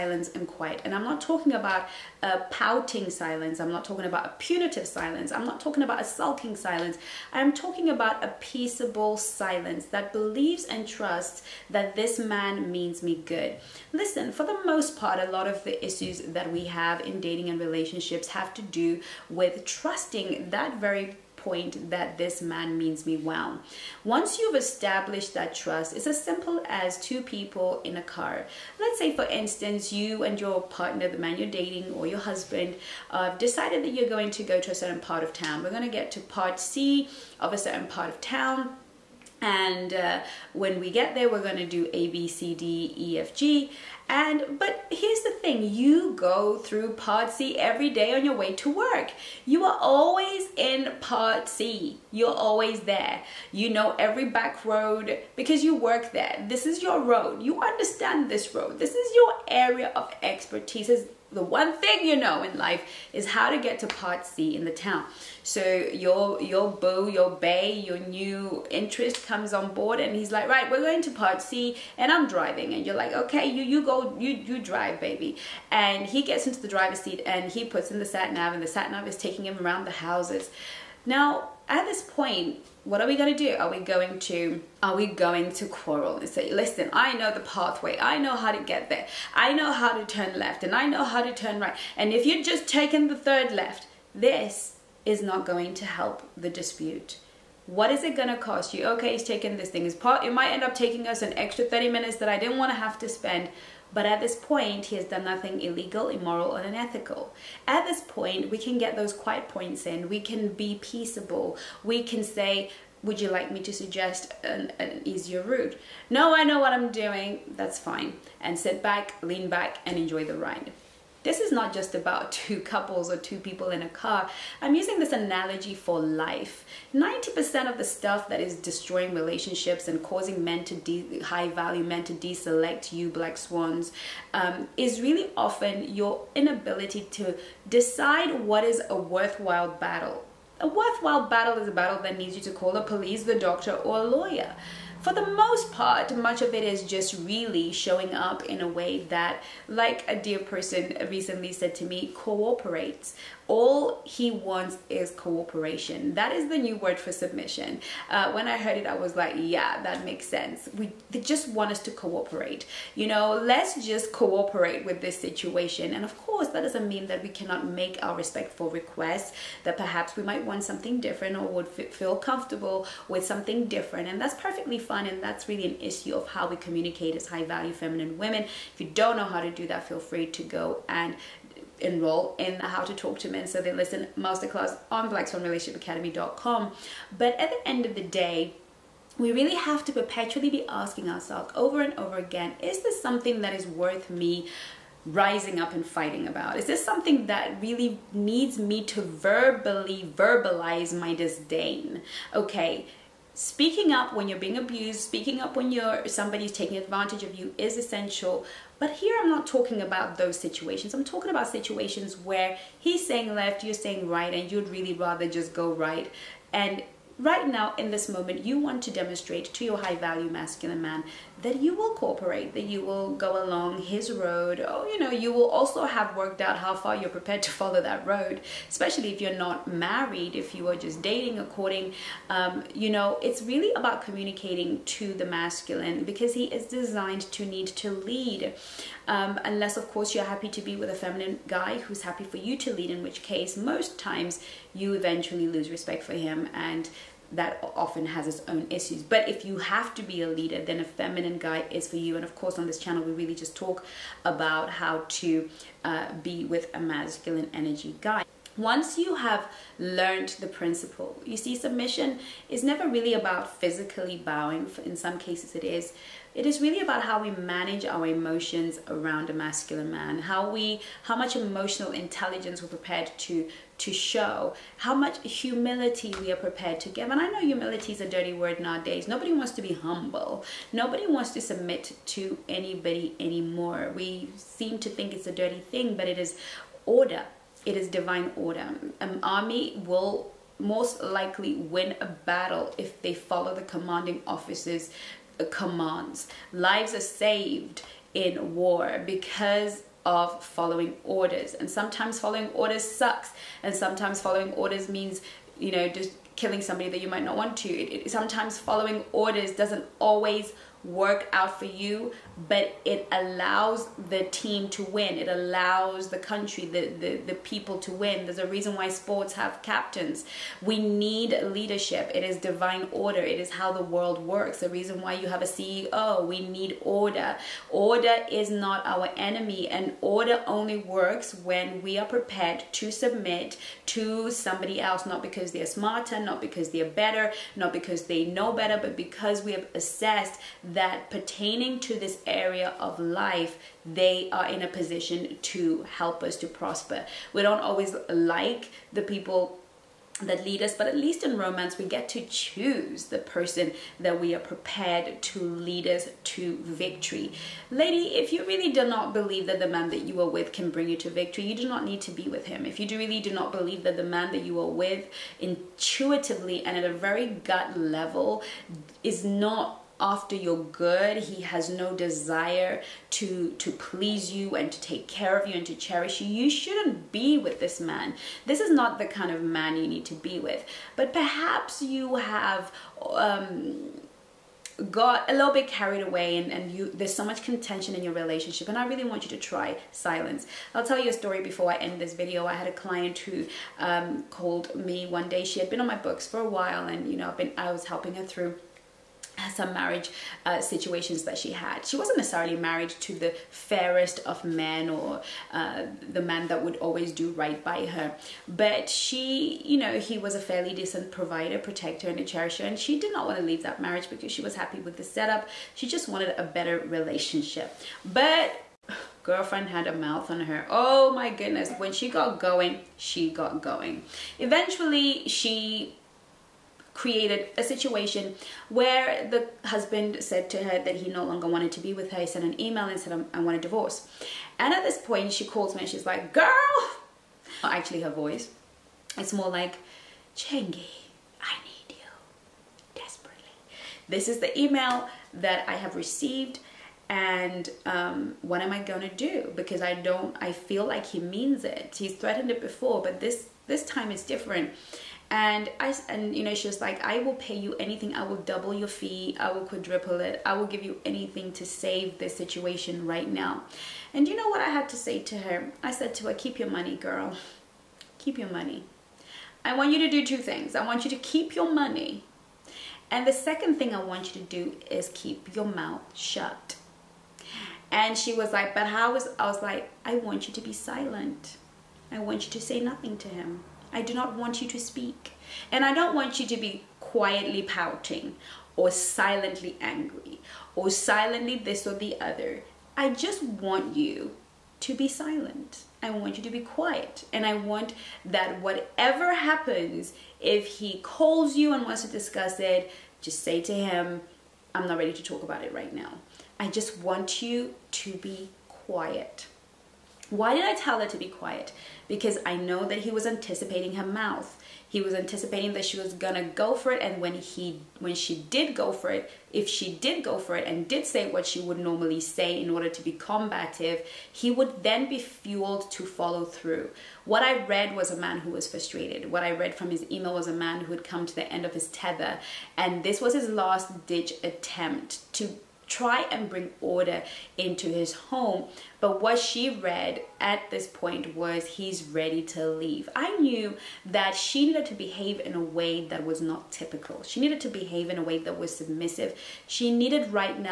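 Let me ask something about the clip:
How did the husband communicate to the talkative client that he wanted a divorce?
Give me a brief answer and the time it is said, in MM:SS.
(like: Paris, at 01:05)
An email, at 07:12.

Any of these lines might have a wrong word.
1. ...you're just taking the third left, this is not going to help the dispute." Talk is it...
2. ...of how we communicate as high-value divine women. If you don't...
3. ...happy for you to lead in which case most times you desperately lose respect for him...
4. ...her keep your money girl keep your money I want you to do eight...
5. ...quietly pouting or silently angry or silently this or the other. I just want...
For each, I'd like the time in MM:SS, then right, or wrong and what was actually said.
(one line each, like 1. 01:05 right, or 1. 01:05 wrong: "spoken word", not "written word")
1. 01:32 wrong: "What", not "Talk"
2. 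02:56 wrong: "feminine", not "divine"
3. 04:02 wrong: "eventually", not "desperately"
4. 07:46 wrong: "two", not "eight"
5. 08:07 right.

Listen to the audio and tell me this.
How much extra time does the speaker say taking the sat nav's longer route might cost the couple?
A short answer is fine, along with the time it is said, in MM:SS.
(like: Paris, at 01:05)
30 minutes, at 01:41.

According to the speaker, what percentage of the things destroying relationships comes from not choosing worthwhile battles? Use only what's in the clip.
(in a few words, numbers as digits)
90%.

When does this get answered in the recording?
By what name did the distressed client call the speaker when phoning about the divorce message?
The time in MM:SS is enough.
07:20.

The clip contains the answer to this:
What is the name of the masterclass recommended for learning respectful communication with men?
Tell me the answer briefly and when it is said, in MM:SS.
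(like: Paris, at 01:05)
How to Talk to Men So They Listen, at 03:02.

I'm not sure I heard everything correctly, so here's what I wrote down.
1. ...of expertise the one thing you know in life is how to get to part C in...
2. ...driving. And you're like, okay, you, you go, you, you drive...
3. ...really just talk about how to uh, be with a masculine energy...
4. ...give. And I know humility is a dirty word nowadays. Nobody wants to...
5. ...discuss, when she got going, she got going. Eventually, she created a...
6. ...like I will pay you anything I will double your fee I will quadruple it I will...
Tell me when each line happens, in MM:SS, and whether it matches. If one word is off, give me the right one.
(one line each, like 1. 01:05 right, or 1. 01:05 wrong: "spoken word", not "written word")
1. 00:59 right
2. 01:12 right
3. 04:13 right
4. 04:36 right
5. 07:01 wrong: "goodness", not "discuss"
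6. 07:36 right.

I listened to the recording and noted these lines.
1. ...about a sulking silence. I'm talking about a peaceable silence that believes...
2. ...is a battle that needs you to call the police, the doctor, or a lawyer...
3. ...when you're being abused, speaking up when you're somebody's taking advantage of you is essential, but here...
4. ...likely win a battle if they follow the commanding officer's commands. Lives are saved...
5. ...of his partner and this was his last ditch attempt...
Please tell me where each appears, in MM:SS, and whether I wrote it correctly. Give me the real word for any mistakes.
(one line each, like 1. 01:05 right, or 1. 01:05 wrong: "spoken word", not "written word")
1. 00:05 right
2. 02:21 right
3. 03:24 right
4. 04:51 right
5. 08:51 wrong: "tether", not "partner".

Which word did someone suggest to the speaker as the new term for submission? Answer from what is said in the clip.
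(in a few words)
Cooperation.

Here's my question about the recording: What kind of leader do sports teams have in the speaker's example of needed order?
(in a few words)
Captains.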